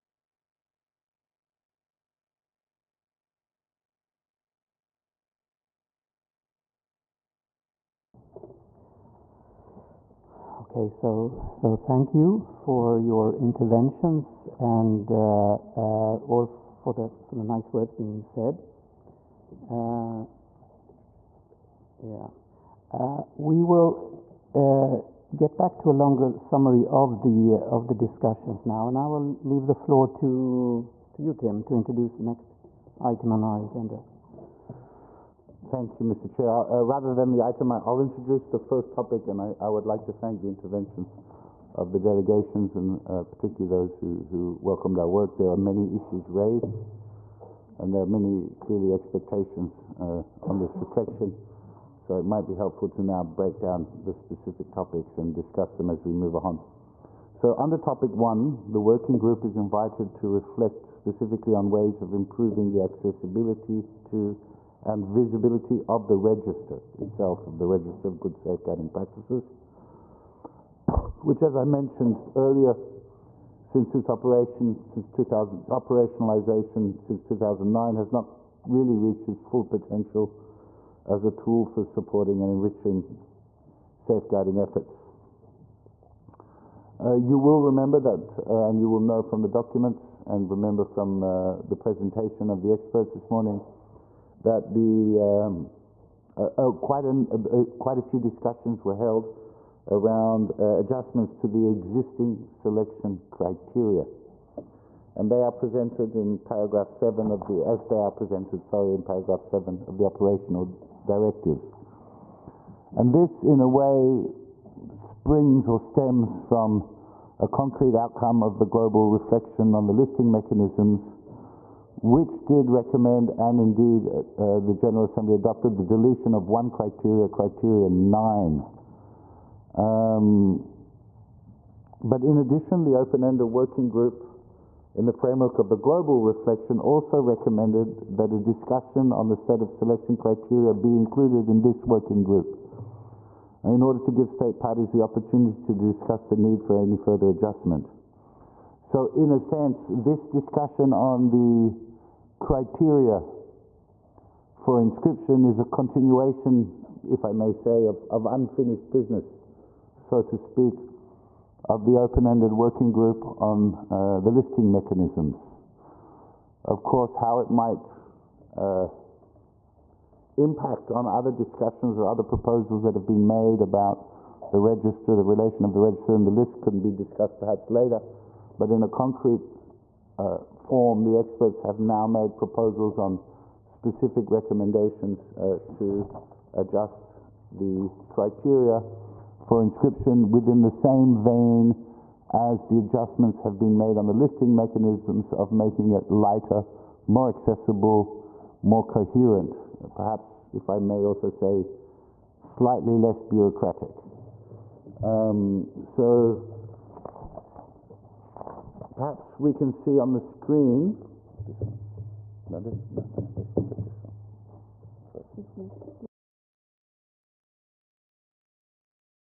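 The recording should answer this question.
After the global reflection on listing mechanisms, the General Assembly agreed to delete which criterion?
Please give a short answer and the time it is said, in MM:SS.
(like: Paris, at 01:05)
Criterion 9, at 02:07.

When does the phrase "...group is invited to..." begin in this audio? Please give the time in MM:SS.
00:59.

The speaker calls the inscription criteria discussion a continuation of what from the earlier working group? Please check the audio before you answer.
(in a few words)
Unfinished business.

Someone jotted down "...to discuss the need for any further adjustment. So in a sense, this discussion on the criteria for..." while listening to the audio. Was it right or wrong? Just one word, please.
right.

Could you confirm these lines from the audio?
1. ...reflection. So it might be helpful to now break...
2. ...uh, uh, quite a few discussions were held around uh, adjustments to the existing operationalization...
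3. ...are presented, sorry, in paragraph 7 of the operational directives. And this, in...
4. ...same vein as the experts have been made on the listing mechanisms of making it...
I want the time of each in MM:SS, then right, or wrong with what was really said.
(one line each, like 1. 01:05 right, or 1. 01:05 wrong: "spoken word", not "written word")
1. 00:50 right
2. 01:37 wrong: "selection", not "operationalization"
3. 01:48 right
4. 03:10 wrong: "adjustments", not "experts".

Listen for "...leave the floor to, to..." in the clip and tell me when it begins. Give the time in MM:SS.
00:29.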